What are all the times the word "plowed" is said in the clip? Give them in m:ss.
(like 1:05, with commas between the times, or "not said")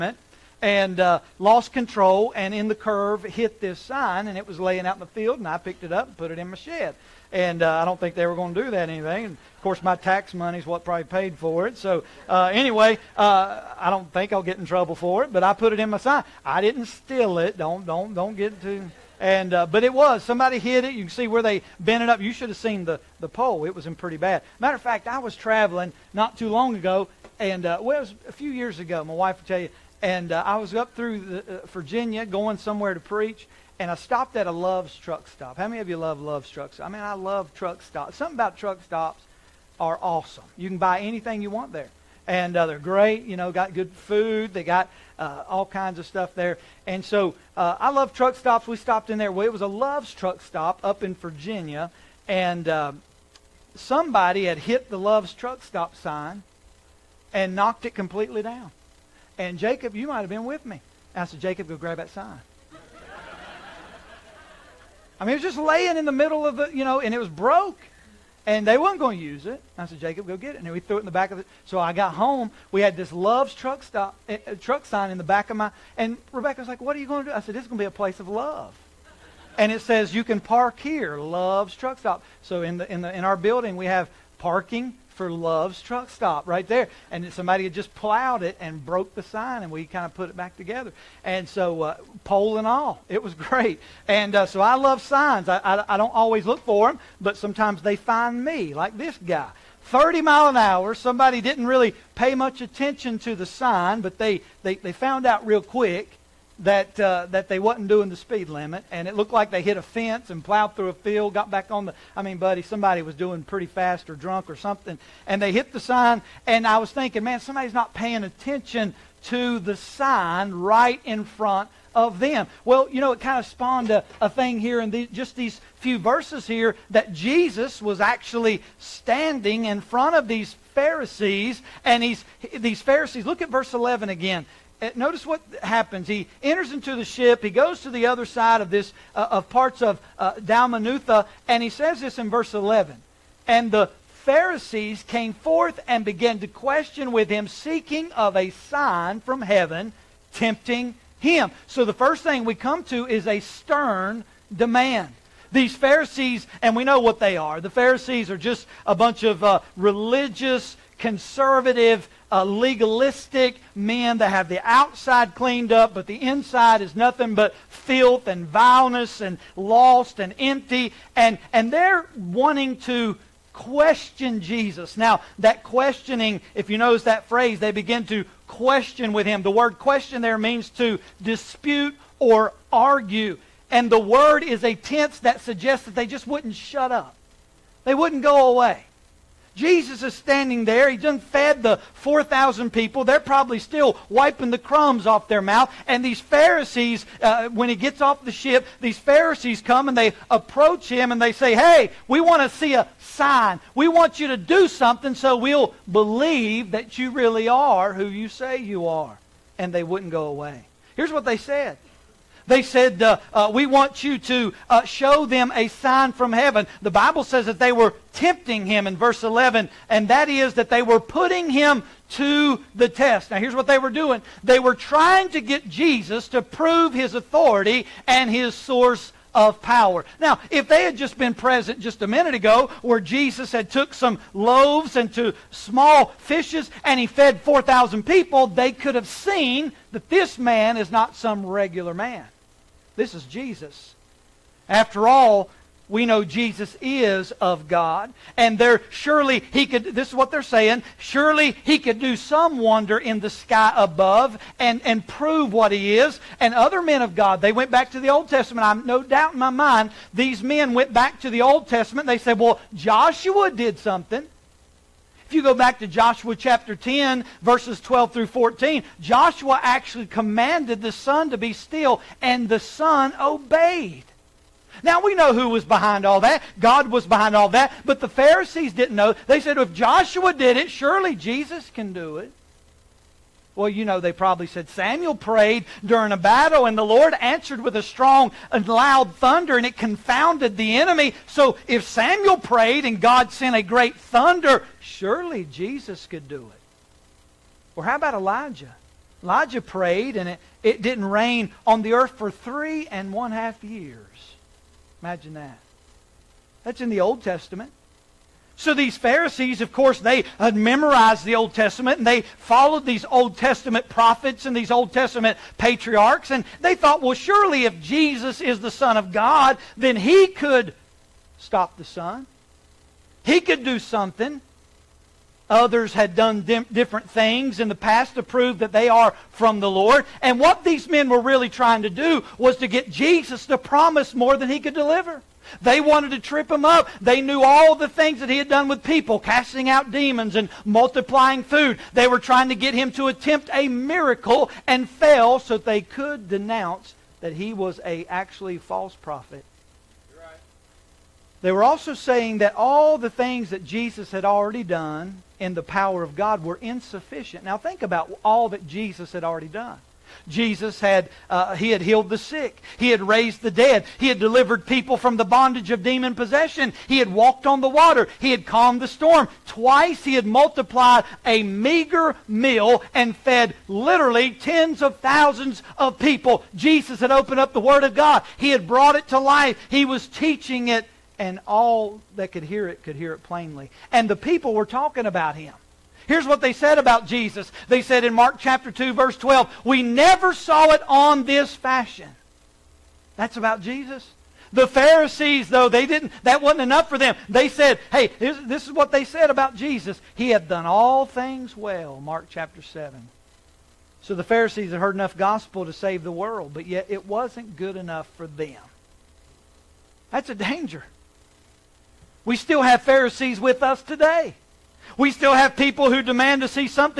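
1:27, 1:50.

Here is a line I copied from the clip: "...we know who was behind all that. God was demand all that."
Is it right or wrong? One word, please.
wrong.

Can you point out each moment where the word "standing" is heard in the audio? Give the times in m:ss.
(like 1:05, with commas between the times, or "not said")
2:08, 3:10.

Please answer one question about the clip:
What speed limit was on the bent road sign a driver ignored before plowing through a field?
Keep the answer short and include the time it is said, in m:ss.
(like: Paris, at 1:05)
30 miles per hour, at 1:39.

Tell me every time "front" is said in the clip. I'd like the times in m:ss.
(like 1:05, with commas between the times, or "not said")
2:01, 2:09.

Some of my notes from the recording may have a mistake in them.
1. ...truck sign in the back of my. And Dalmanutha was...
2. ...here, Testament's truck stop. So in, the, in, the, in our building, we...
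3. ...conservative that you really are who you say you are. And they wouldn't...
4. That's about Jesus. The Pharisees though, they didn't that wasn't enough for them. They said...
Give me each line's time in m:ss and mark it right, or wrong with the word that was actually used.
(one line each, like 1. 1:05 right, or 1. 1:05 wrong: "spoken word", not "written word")
1. 1:14 wrong: "Rebecca", not "Dalmanutha"
2. 1:20 wrong: "Love", not "Testament"
3. 3:25 wrong: "believe", not "conservative"
4. 6:33 right.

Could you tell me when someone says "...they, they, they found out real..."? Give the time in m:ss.
1:44.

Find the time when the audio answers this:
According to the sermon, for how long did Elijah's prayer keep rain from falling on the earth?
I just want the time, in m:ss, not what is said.
5:02.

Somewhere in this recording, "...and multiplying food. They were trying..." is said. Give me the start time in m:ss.
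5:40.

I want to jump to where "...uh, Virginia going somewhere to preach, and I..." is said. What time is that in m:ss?
0:31.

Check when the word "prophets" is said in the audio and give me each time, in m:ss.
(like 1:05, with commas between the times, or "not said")
5:13, 5:48.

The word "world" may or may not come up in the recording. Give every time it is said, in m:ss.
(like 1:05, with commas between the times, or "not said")
6:46.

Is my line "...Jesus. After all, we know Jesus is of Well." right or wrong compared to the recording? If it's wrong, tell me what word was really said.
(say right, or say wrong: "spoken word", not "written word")
wrong: "God", not "Well".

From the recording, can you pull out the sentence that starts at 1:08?
And they weren't going to use it.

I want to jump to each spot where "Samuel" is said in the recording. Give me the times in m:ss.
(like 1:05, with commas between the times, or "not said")
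4:44, 4:51.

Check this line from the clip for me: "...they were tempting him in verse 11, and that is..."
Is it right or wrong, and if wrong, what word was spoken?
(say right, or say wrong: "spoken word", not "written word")
right.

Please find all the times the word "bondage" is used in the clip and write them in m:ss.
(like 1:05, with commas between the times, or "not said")
6:05.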